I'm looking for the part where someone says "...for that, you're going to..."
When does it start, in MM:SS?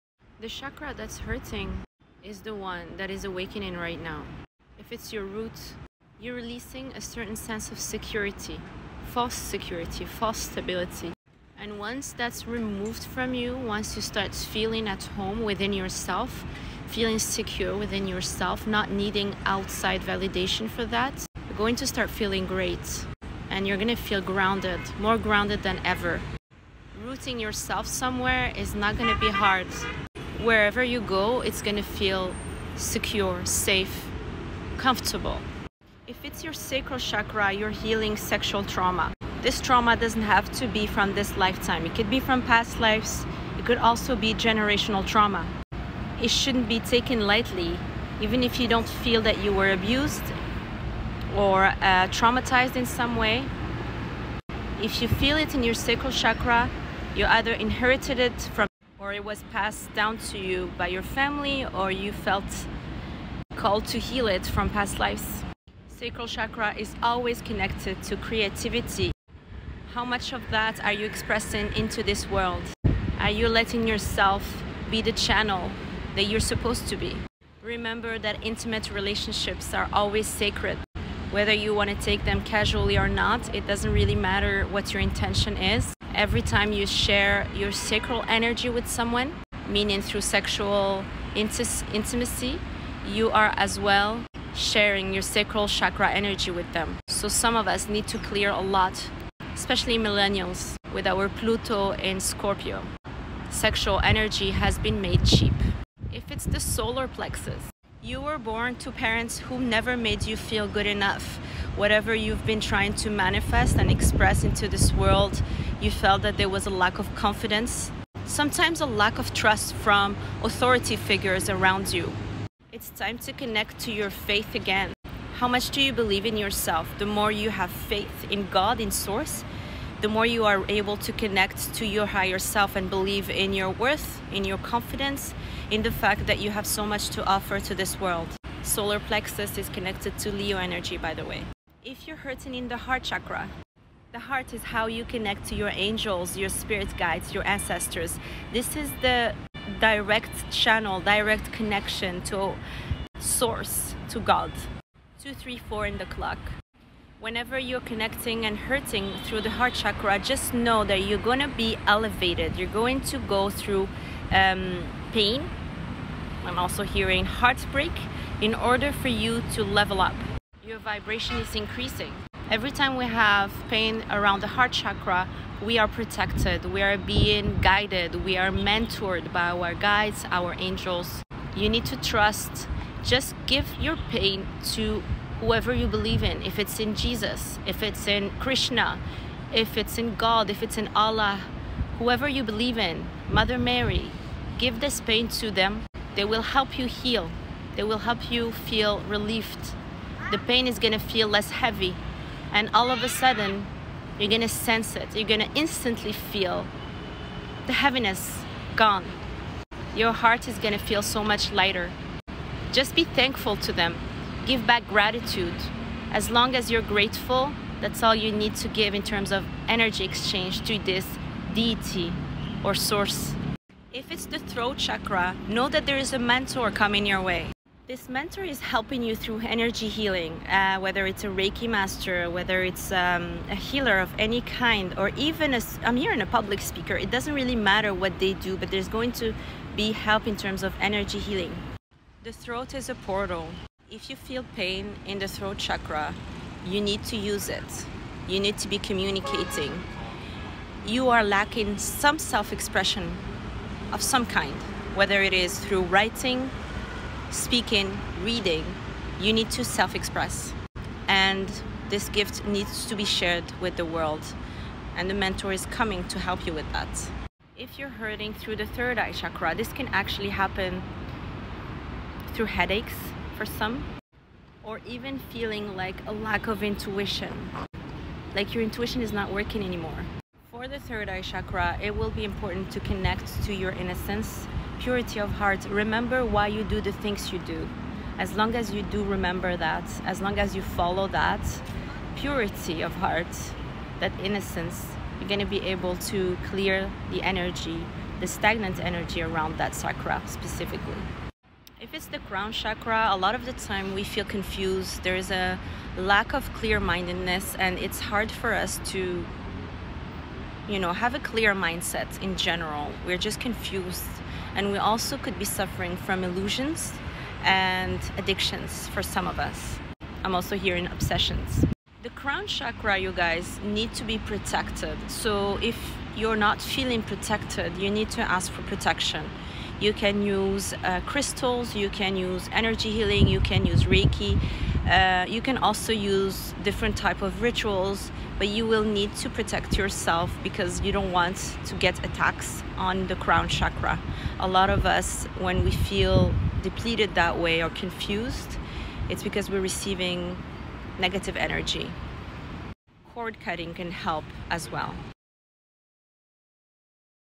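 00:20.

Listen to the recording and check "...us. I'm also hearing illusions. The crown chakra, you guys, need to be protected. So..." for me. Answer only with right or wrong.
wrong.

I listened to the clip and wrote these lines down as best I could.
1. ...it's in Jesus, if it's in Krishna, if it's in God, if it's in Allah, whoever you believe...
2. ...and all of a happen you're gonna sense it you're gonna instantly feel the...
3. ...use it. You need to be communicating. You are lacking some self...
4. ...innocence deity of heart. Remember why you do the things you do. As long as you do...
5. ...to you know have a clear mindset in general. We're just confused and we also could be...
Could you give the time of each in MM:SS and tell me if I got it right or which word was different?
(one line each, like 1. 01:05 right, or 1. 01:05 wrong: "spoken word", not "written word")
1. 03:06 right
2. 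03:22 wrong: "sudden", not "happen"
3. 04:07 right
4. 04:43 wrong: "purity", not "deity"
5. 05:08 right.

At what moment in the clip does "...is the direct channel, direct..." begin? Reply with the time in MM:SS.
02:28.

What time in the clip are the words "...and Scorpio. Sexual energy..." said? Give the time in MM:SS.
01:41.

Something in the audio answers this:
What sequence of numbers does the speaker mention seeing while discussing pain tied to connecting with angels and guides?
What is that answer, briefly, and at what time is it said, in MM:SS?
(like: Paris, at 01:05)
2, 3, 4, at 02:35.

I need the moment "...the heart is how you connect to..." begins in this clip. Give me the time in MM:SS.
02:24.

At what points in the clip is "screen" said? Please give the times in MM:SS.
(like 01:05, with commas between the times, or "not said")
not said.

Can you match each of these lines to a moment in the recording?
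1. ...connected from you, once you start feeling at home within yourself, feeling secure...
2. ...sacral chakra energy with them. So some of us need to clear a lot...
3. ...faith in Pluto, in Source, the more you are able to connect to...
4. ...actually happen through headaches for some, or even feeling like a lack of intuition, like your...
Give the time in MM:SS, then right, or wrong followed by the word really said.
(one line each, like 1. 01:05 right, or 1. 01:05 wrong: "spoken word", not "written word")
1. 00:12 wrong: "removed", not "connected"
2. 01:35 right
3. 02:07 wrong: "God", not "Pluto"
4. 04:29 right.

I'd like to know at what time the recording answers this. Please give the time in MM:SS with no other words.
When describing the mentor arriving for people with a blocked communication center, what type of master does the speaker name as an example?
03:51.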